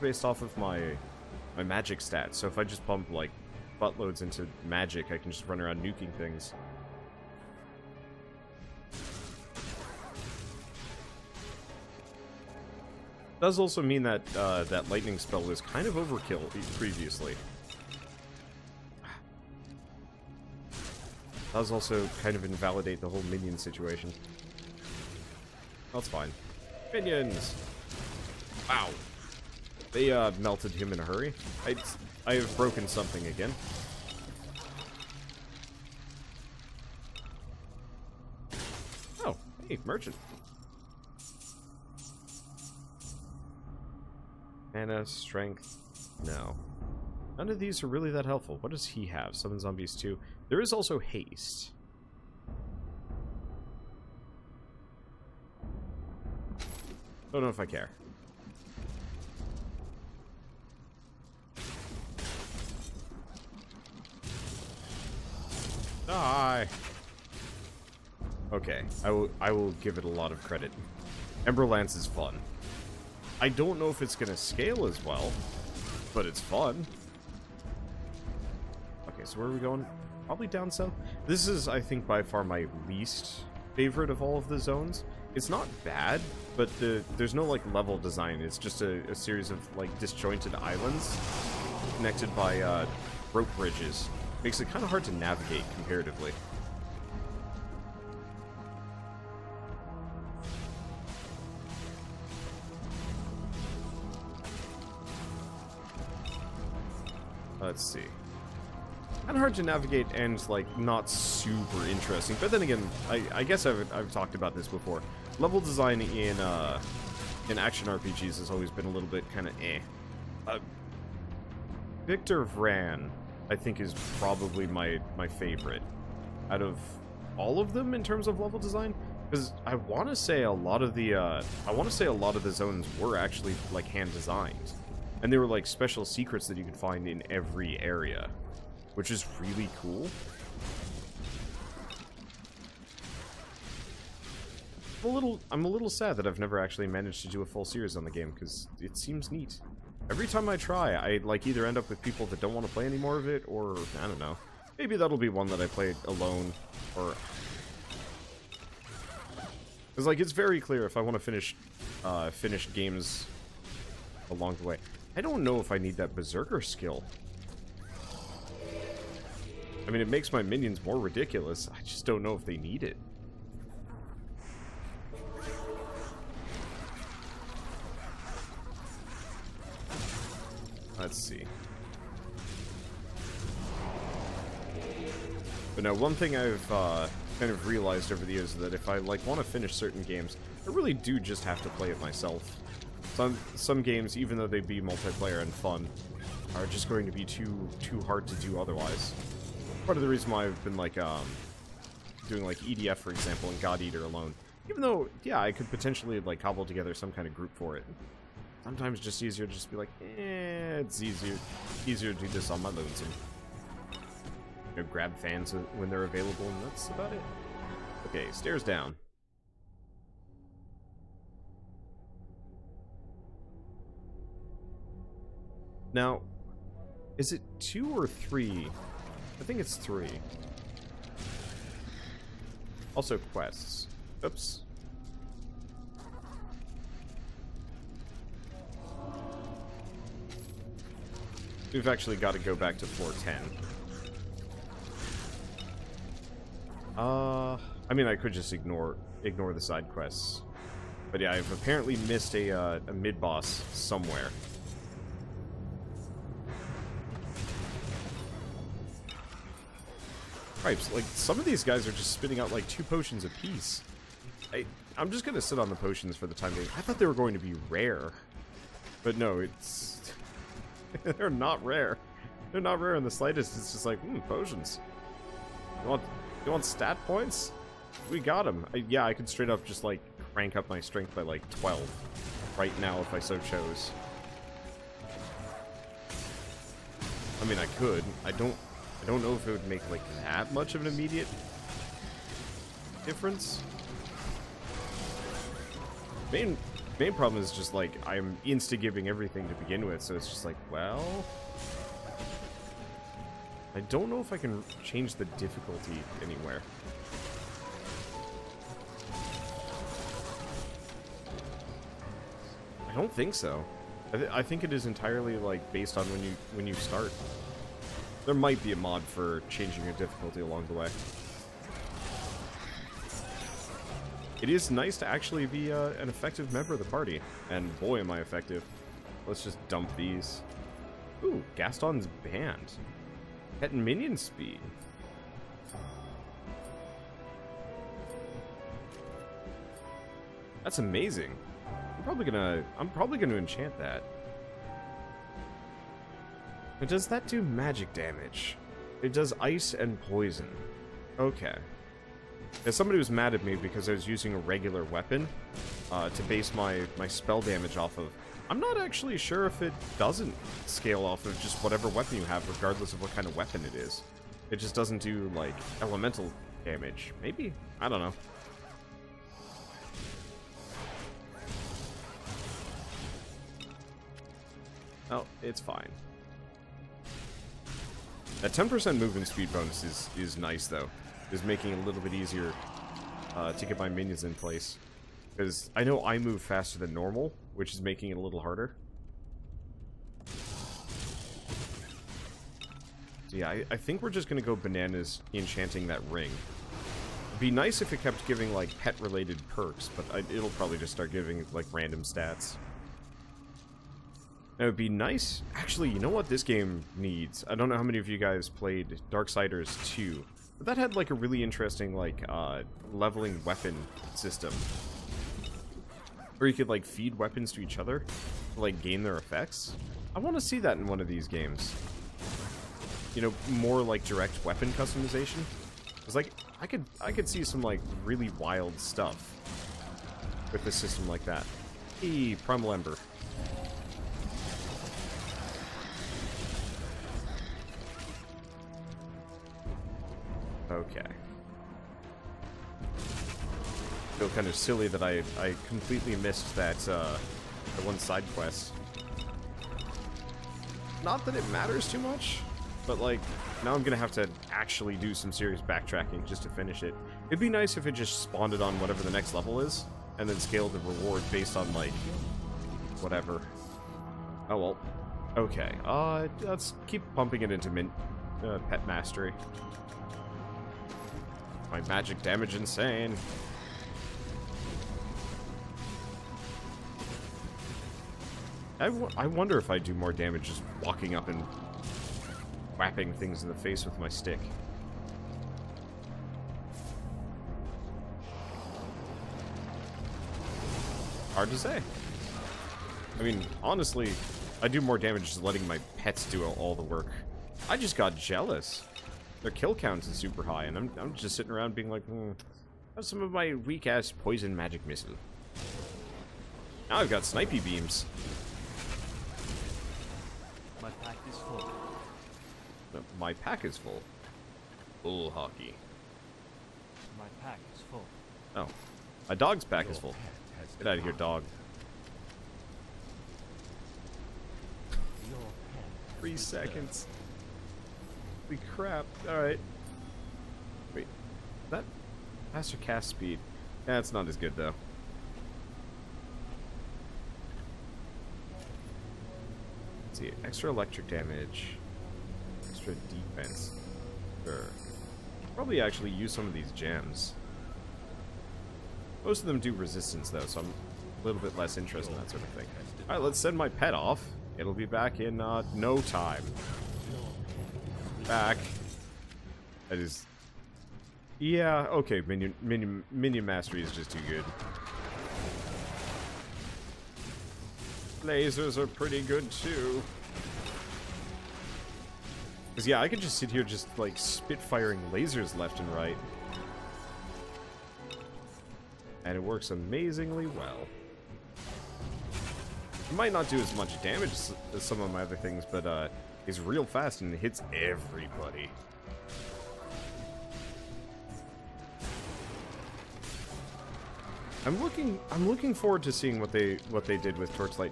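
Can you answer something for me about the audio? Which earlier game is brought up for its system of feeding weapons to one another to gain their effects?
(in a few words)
Darksiders 2.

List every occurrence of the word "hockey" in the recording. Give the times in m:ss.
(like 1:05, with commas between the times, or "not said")
8:35.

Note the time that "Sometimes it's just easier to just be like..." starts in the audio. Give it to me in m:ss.
3:28.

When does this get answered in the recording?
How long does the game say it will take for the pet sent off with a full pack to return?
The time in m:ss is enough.
8:46.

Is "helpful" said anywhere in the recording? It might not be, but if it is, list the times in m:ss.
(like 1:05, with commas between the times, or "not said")
0:48.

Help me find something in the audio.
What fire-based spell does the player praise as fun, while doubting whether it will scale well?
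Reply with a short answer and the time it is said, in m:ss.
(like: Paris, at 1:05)
Ember Lance, at 1:11.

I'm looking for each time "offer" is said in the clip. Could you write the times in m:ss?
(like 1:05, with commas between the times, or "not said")
not said.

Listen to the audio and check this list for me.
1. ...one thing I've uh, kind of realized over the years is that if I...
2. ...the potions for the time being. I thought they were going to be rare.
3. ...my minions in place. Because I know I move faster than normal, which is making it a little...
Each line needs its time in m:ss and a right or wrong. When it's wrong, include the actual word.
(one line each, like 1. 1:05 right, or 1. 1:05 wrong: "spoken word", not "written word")
1. 3:05 right
2. 4:25 right
3. 6:23 right.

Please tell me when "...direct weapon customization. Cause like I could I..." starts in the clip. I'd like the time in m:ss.
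7:04.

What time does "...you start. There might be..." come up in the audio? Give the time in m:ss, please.
5:16.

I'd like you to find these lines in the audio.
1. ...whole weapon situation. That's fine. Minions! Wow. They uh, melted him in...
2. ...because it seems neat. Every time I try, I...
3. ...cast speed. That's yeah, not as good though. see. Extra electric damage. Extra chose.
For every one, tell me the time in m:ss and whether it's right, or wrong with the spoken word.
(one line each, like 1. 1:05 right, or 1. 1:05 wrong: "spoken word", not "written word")
1. 0:23 wrong: "minion", not "weapon"
2. 2:28 right
3. 8:52 wrong: "defense", not "chose".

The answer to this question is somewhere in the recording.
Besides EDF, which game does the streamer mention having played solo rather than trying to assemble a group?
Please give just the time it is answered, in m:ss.
3:23.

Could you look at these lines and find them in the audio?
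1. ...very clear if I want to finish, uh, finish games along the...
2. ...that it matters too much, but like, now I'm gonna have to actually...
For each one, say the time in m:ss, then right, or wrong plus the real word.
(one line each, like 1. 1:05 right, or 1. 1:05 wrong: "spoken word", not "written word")
1. 2:40 right
2. 7:31 right.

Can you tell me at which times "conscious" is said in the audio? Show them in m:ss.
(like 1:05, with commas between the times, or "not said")
not said.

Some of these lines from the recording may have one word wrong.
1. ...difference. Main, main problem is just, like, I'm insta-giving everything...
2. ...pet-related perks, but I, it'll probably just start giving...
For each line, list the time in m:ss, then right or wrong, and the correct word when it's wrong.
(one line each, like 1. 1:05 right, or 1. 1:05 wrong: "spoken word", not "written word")
1. 4:53 right
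2. 6:38 right.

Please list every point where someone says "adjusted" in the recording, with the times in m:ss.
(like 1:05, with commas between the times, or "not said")
not said.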